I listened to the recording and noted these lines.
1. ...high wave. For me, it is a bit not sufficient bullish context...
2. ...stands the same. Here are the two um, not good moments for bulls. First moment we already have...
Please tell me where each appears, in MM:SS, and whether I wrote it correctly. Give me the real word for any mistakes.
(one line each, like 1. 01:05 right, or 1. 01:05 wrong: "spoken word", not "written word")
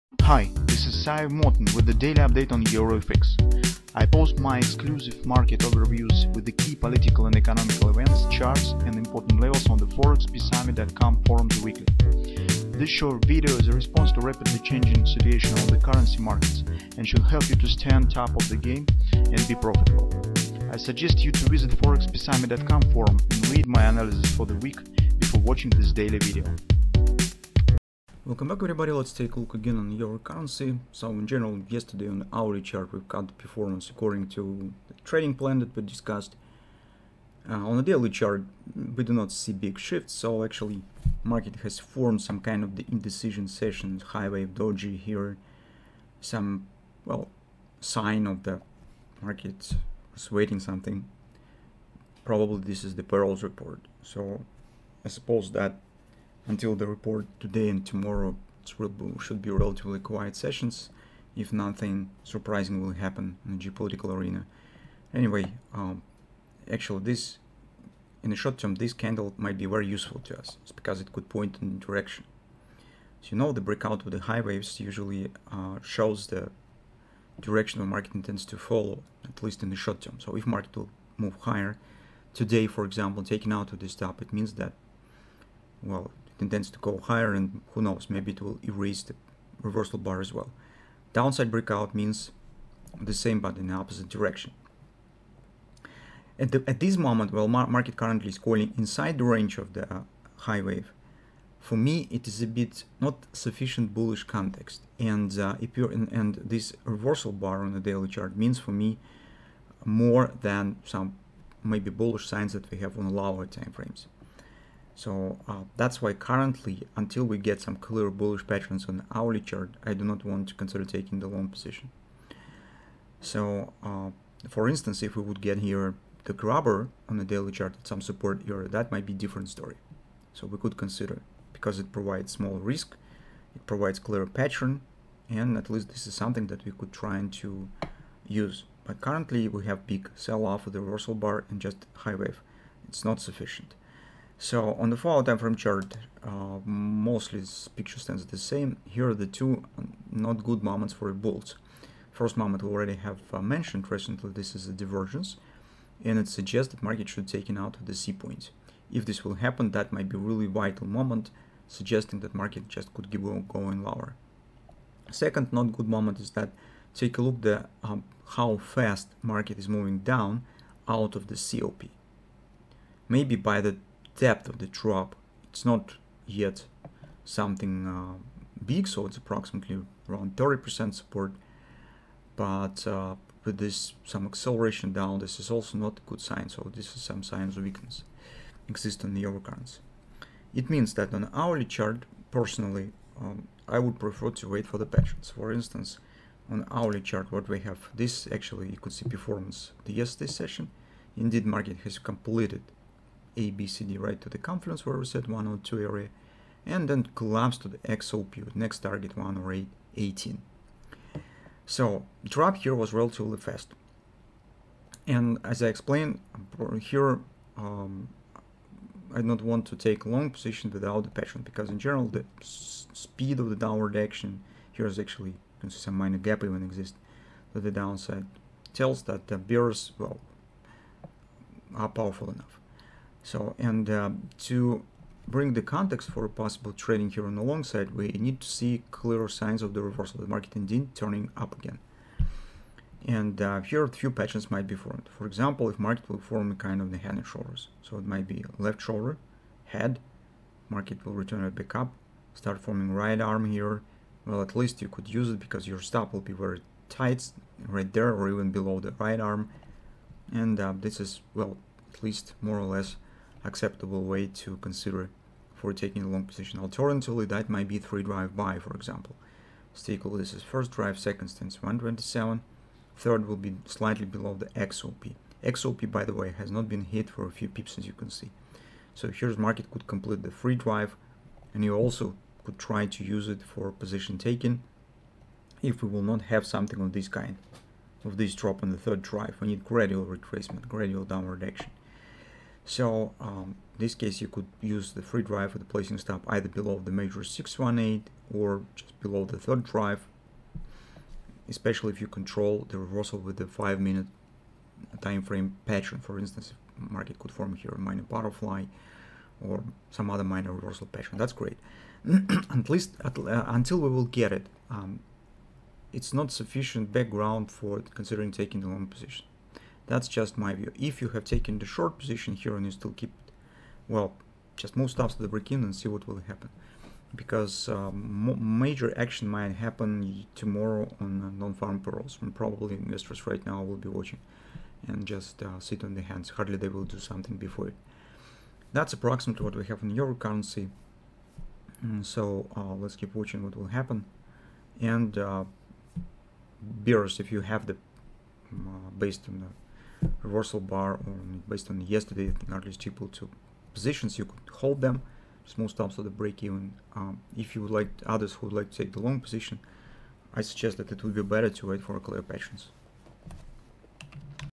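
1. 01:40 right
2. 02:27 right.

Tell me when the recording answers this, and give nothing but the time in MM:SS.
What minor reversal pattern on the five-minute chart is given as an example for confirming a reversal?
05:08.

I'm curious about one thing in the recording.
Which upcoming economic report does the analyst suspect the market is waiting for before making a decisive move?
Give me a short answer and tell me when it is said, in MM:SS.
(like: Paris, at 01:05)
Payrolls report, at 00:53.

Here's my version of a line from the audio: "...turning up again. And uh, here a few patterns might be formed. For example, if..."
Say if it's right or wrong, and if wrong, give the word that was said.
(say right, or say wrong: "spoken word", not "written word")
right.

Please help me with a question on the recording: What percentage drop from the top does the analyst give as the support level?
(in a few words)
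30%.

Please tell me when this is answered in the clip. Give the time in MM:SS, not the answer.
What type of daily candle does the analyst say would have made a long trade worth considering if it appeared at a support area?
02:06.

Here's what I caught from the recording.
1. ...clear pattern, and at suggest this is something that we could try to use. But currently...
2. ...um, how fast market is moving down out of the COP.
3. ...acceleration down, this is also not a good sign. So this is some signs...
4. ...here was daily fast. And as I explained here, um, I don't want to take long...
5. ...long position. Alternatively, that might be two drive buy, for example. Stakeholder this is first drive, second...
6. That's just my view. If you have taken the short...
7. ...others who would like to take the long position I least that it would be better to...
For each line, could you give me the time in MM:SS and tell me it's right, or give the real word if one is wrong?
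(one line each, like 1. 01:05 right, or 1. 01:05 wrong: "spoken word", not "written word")
1. 02:13 wrong: "least", not "suggest"
2. 02:47 right
3. 03:04 right
4. 03:32 wrong: "relatively", not "daily"
5. 04:26 wrong: "three", not "two"
6. 05:19 right
7. 05:58 wrong: "suggest", not "least".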